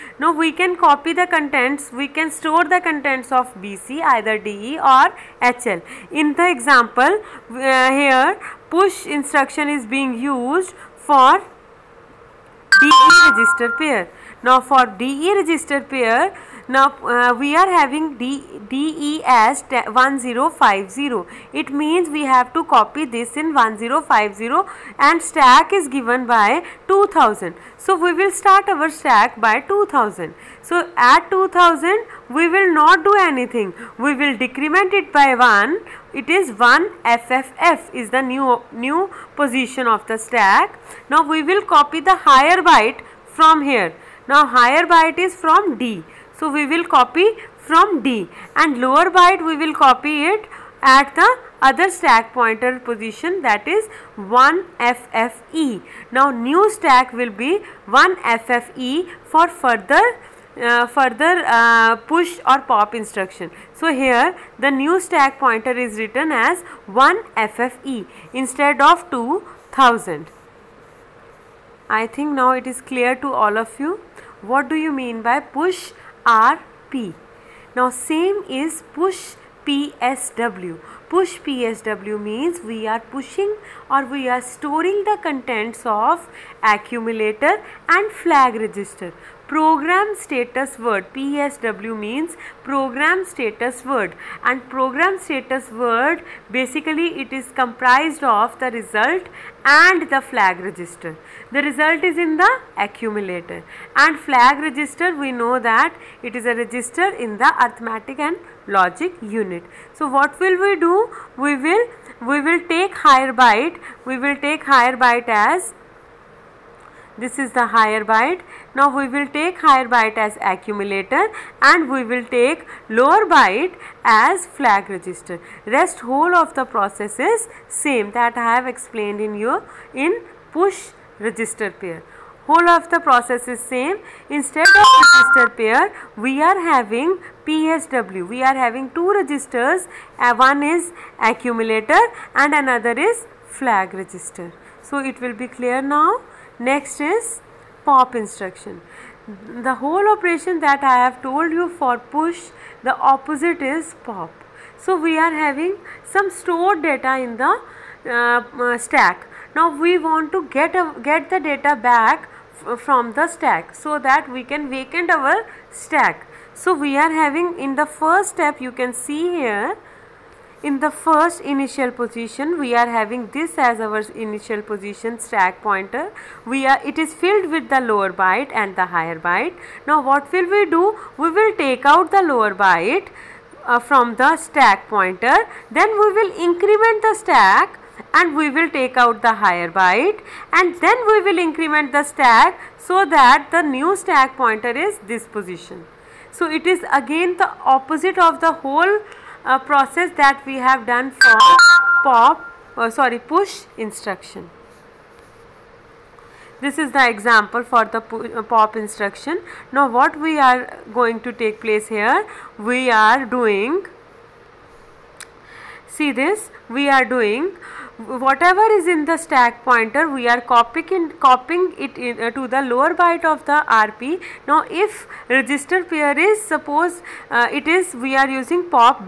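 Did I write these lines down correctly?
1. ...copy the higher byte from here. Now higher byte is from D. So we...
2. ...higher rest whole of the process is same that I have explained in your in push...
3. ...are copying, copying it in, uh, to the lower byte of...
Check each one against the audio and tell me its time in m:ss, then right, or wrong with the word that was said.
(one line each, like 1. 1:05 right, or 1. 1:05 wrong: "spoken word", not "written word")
1. 0:41 right
2. 2:04 wrong: "register", not "higher"
3. 3:40 right.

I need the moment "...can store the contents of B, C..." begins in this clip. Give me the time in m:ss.
0:02.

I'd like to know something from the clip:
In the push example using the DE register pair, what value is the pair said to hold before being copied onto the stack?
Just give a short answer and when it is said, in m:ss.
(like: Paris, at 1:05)
1050, at 0:18.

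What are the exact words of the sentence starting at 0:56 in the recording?
Now new stack will be 1FFE for further uh, further uh, push or pop instruction.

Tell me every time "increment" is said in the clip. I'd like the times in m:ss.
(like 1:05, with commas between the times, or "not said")
3:06, 3:11.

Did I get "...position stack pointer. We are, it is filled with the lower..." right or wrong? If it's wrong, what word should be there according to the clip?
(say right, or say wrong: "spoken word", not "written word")
right.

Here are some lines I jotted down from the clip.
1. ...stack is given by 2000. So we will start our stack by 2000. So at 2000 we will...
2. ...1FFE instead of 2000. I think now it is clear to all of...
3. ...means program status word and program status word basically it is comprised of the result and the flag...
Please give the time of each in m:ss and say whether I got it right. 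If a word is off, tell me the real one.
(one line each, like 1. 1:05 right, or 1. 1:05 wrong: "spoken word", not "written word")
1. 0:25 right
2. 1:06 right
3. 1:31 right.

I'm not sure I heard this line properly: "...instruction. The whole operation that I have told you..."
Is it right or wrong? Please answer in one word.
right.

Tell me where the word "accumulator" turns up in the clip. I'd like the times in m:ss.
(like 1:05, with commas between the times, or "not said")
1:26, 1:42, 2:00, 2:21.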